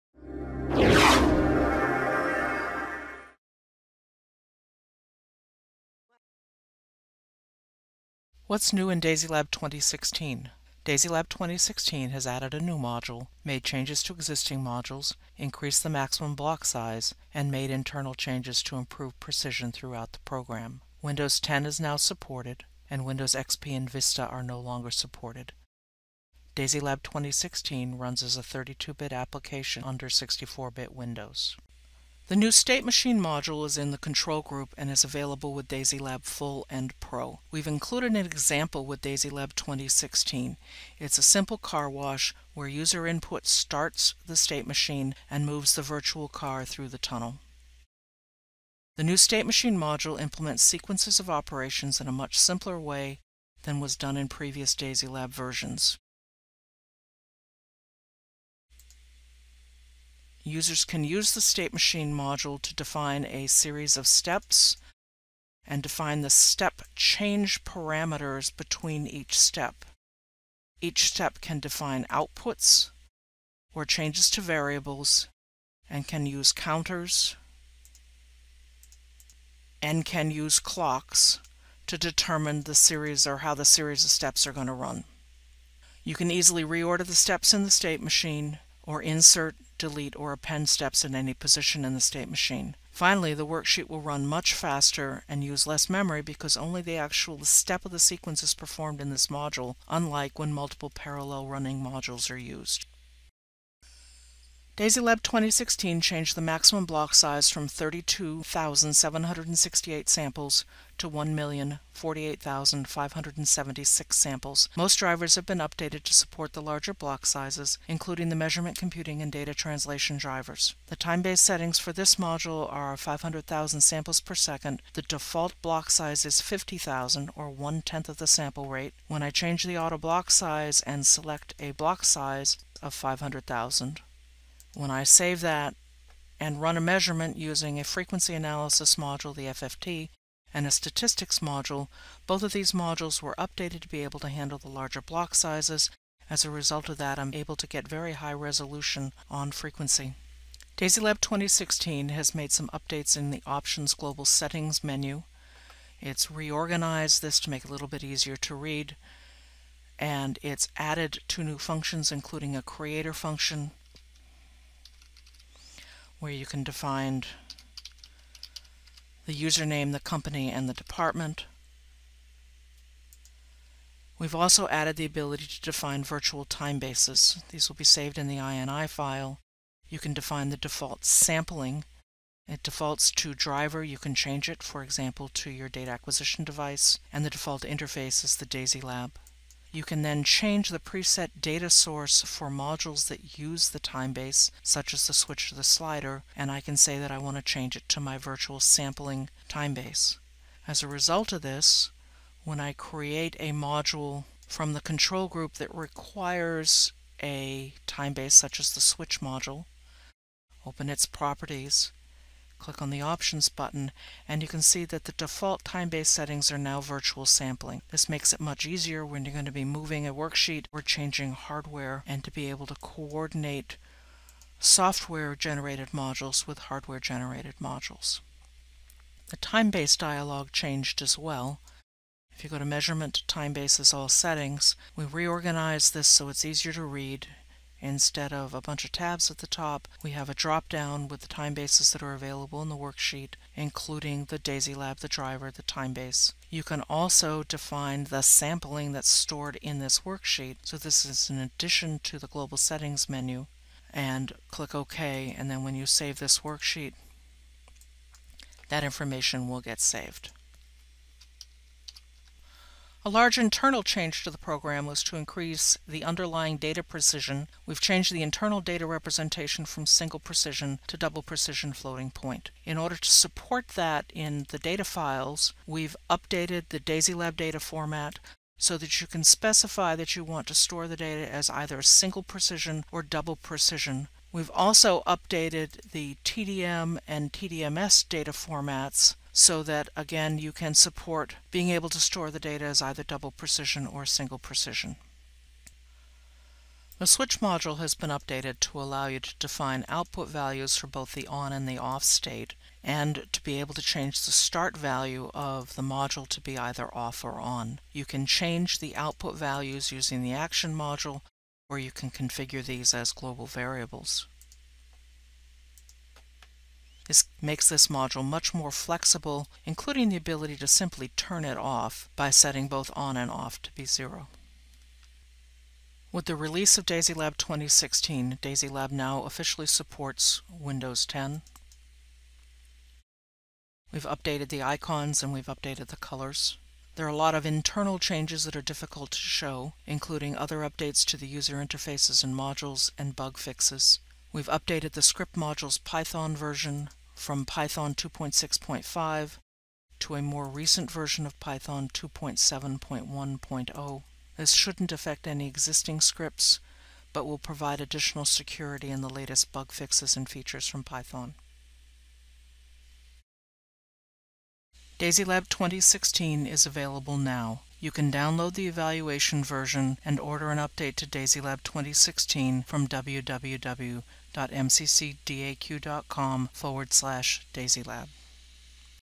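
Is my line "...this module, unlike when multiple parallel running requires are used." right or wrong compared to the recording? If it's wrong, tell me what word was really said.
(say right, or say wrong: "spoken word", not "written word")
wrong: "modules", not "requires".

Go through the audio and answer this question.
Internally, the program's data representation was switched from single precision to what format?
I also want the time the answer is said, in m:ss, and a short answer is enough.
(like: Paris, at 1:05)
double precision floating point, at 4:30.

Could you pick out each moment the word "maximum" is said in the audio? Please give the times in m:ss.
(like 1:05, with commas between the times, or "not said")
0:15, 1:46.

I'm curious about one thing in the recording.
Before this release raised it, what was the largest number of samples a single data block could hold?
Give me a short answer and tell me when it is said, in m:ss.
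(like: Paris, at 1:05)
32,768, at 1:47.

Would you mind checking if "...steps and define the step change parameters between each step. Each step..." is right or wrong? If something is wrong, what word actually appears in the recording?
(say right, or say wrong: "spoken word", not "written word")
right.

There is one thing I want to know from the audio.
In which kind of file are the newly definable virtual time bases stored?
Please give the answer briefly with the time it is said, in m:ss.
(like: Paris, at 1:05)
INI file, at 2:58.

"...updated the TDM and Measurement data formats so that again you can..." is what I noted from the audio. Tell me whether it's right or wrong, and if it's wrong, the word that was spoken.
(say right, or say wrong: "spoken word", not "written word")
wrong: "TDMS", not "Measurement".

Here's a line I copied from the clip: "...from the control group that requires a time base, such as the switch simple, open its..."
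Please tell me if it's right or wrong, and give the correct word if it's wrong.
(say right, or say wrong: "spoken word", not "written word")
wrong: "module", not "simple".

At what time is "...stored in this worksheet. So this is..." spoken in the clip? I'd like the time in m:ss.
4:09.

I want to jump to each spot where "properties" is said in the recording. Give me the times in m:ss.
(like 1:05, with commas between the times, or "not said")
3:31.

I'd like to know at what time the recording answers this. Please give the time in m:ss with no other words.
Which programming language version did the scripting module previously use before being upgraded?
5:47.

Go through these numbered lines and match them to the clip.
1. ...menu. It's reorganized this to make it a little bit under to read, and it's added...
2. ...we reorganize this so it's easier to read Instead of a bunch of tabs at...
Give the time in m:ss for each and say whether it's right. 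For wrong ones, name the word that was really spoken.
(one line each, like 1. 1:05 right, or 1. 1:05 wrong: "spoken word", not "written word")
1. 2:34 wrong: "easier", not "under"
2. 3:54 right.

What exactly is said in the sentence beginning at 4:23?
A large internal change to the program was to increase the underlying data precision.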